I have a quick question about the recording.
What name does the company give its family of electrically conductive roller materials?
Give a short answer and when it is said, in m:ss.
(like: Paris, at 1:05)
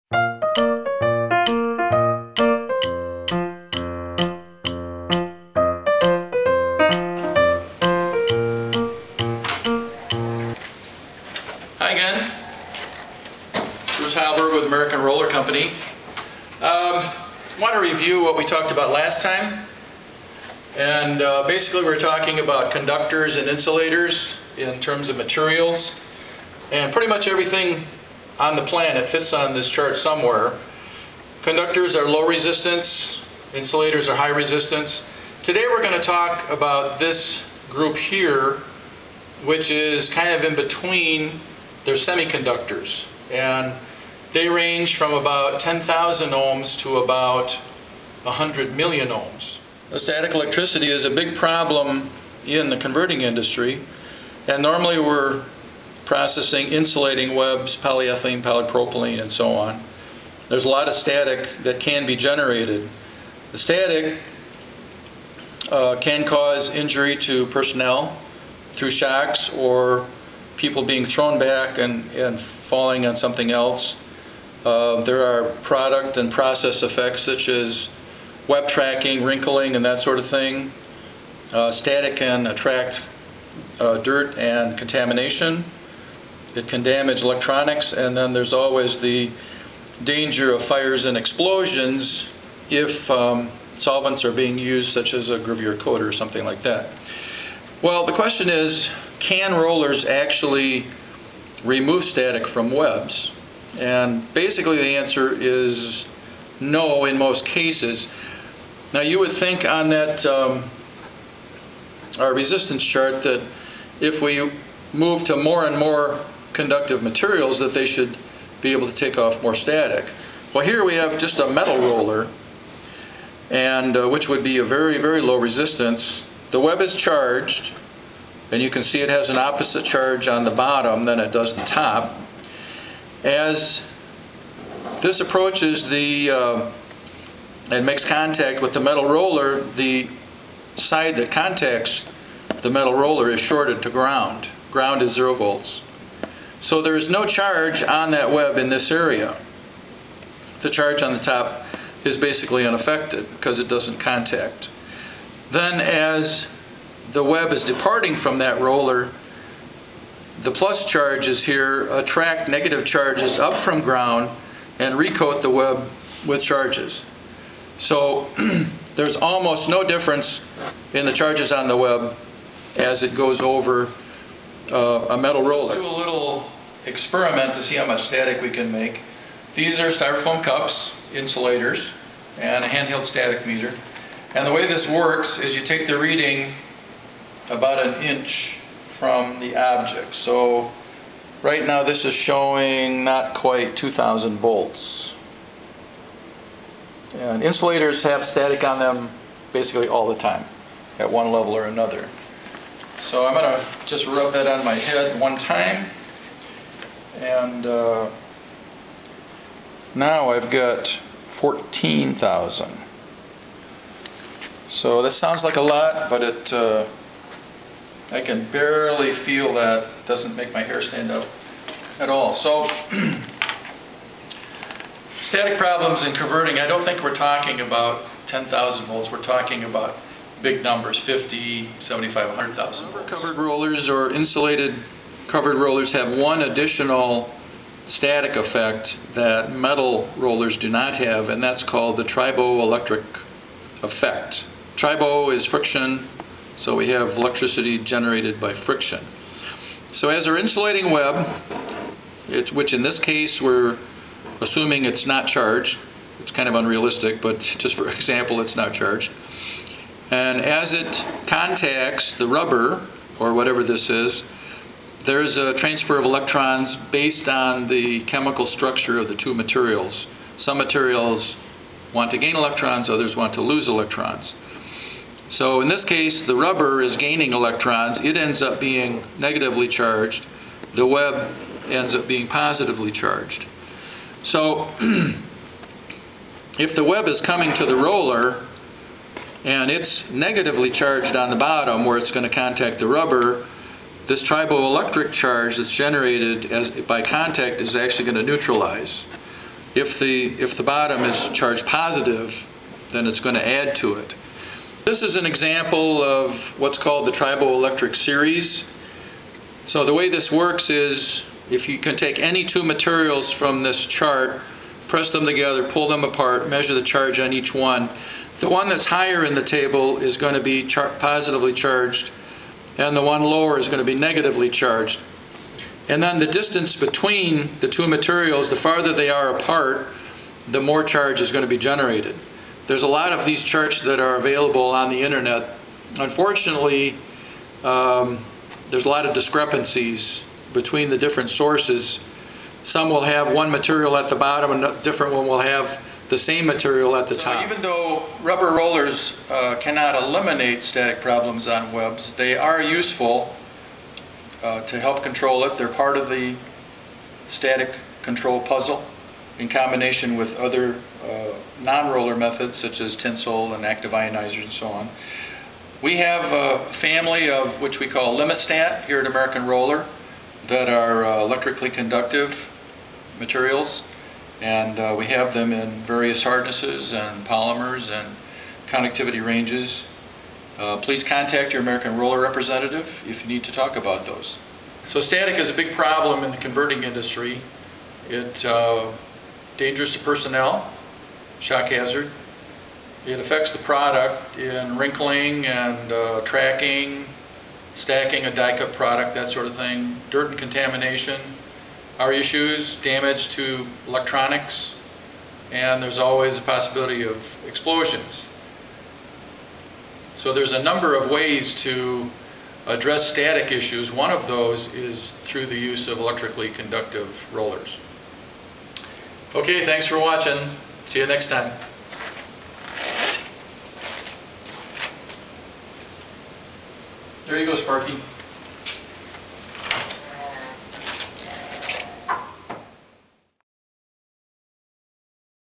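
Limistat, at 6:08.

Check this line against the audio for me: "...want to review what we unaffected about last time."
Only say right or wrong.
wrong.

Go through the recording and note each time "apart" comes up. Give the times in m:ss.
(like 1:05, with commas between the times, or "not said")
5:16, 5:29.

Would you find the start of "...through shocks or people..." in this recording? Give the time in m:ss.
1:08.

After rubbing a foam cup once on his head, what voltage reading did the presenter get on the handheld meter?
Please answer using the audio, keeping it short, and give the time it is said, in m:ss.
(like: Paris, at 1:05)
14,000, at 3:31.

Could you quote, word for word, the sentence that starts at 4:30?
Some materials want to gain electrons, others want to lose electrons.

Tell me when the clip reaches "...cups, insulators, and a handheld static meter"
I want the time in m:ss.
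3:00.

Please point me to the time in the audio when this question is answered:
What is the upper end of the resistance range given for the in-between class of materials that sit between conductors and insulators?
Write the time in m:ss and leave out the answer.
0:48.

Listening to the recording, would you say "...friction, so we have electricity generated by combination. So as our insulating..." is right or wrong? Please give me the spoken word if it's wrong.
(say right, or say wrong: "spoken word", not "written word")
wrong: "friction", not "combination".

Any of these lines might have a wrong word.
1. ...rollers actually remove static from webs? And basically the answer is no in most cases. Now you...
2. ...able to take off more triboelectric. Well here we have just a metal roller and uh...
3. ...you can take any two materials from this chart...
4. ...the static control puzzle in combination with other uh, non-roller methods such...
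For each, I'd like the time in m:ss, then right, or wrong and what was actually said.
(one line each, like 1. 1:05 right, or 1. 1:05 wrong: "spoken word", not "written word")
1. 1:39 right
2. 1:58 wrong: "static", not "triboelectric"
3. 5:11 right
4. 5:56 right.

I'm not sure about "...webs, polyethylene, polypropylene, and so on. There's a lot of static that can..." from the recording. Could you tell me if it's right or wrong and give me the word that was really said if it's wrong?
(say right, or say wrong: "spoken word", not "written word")
right.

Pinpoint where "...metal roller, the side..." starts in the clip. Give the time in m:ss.
2:18.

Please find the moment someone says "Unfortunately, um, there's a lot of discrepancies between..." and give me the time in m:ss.
5:35.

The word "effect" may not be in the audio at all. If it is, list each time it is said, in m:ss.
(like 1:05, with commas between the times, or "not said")
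1:16, 3:58, 4:03.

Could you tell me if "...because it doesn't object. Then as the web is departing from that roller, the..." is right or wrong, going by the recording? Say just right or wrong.
wrong.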